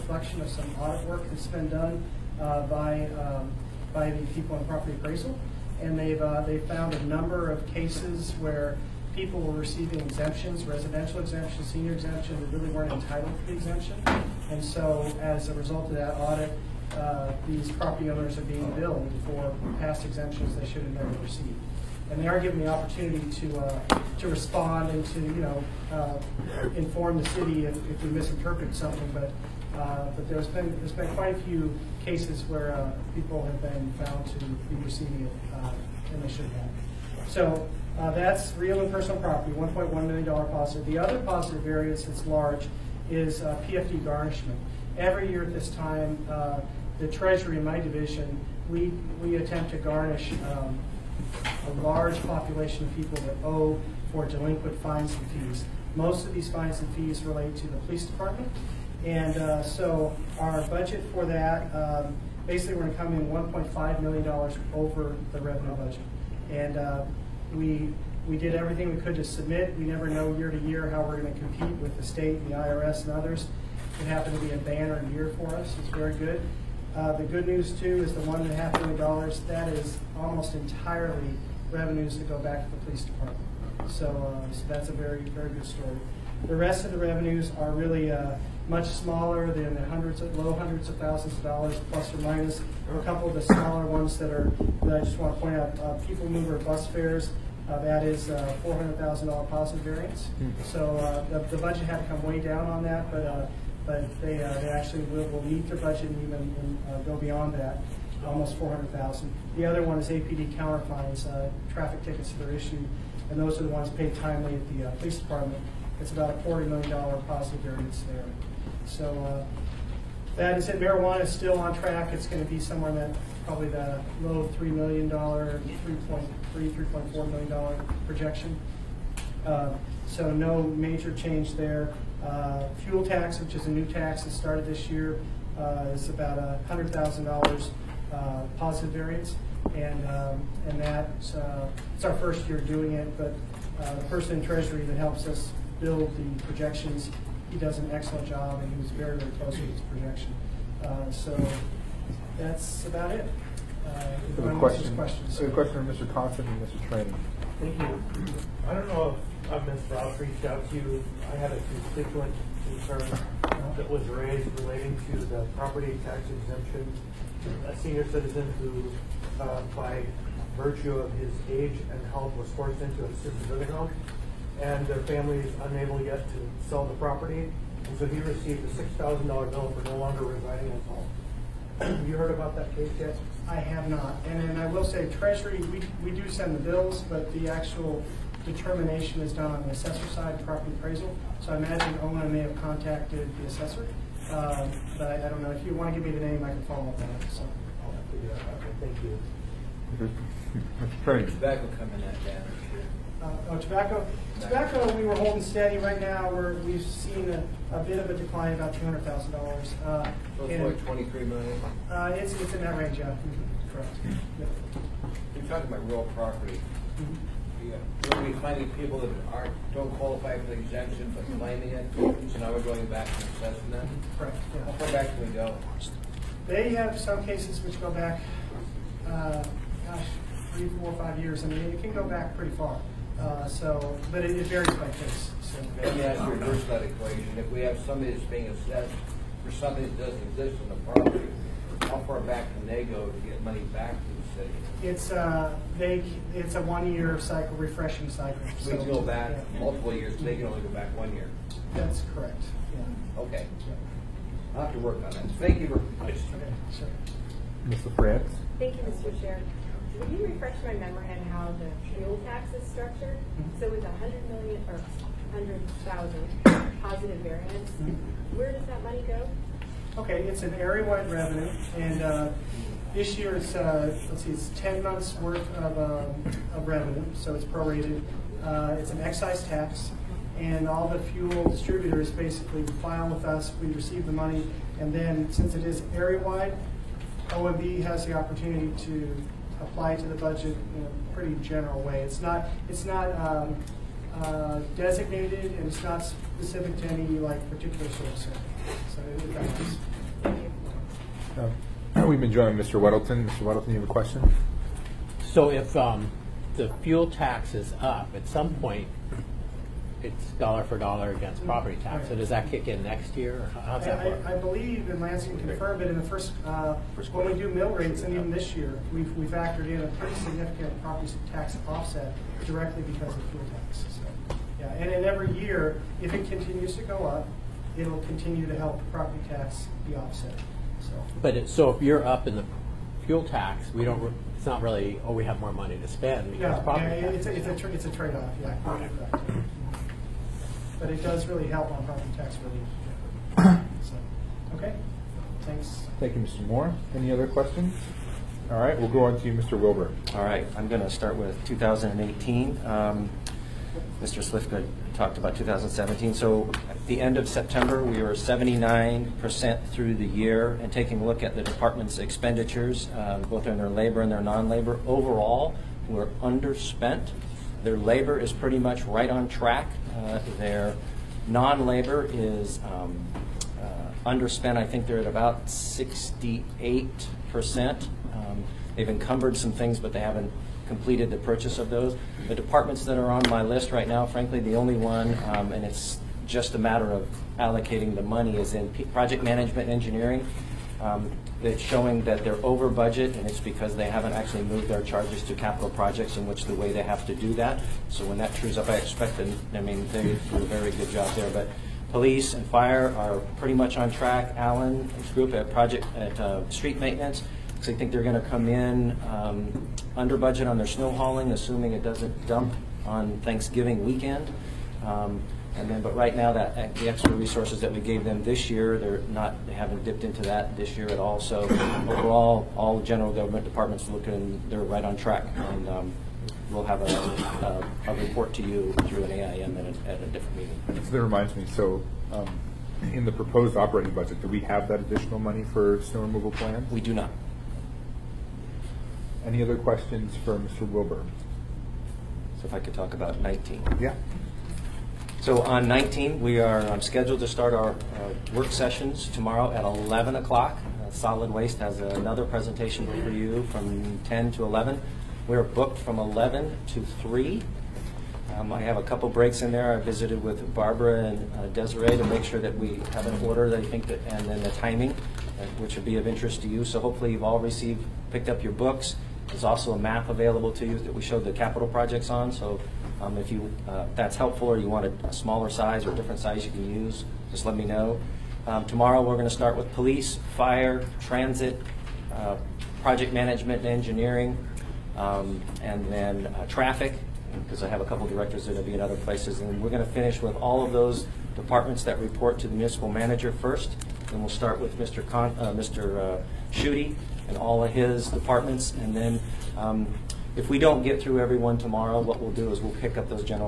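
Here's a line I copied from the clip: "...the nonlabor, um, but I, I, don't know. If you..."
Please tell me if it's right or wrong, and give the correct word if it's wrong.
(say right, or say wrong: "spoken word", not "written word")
wrong: "assessor", not "nonlabor".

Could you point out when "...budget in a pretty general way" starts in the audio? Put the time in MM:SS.
04:50.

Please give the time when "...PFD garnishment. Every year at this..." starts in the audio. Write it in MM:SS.
00:43.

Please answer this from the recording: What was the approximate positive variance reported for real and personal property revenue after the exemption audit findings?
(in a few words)
$1.1 million.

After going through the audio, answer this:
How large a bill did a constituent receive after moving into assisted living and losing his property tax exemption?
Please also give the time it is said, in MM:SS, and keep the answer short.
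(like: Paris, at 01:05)
$6,000, at 02:58.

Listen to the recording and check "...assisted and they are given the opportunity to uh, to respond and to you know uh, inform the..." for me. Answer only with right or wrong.
wrong.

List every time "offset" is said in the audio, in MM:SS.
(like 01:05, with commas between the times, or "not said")
05:21, 05:29.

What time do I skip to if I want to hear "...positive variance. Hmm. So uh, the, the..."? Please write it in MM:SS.
01:39.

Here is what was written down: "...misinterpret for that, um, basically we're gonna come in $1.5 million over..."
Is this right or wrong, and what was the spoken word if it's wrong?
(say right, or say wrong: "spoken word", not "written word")
wrong: "budget", not "misinterpret".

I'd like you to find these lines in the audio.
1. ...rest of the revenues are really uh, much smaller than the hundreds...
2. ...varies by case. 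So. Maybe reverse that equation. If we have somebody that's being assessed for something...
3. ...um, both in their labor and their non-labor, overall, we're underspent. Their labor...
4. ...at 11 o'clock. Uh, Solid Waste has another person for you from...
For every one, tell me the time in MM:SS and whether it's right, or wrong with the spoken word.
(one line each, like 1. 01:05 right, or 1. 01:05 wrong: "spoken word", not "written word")
1. 01:26 right
2. 03:54 right
3. 06:02 right
4. 07:29 wrong: "presentation", not "person".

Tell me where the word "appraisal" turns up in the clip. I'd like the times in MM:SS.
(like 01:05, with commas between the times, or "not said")
00:04, 03:10.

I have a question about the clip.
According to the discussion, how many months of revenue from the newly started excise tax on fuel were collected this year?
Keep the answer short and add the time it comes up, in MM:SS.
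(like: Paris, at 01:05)
10 months, at 04:34.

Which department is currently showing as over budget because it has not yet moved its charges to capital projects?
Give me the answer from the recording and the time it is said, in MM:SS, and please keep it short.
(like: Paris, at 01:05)
project management engineering, at 06:28.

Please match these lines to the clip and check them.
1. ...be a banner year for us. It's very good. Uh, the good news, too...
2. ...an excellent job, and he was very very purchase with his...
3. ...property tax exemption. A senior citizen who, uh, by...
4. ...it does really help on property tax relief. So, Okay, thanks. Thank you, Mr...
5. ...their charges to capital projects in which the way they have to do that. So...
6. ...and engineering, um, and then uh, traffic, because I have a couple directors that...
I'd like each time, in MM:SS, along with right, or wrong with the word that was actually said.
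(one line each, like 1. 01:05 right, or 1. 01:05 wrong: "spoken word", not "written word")
1. 01:14 right
2. 02:27 wrong: "close", not "purchase"
3. 02:45 right
4. 05:40 right
5. 06:34 right
6. 08:03 right.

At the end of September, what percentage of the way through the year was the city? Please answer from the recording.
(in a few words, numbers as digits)
79%.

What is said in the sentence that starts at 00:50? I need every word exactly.
Um, a large population of people that owe for delinquent fines and fees.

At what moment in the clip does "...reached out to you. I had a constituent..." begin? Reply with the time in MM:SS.
02:40.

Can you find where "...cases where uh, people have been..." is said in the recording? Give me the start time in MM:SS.
00:32.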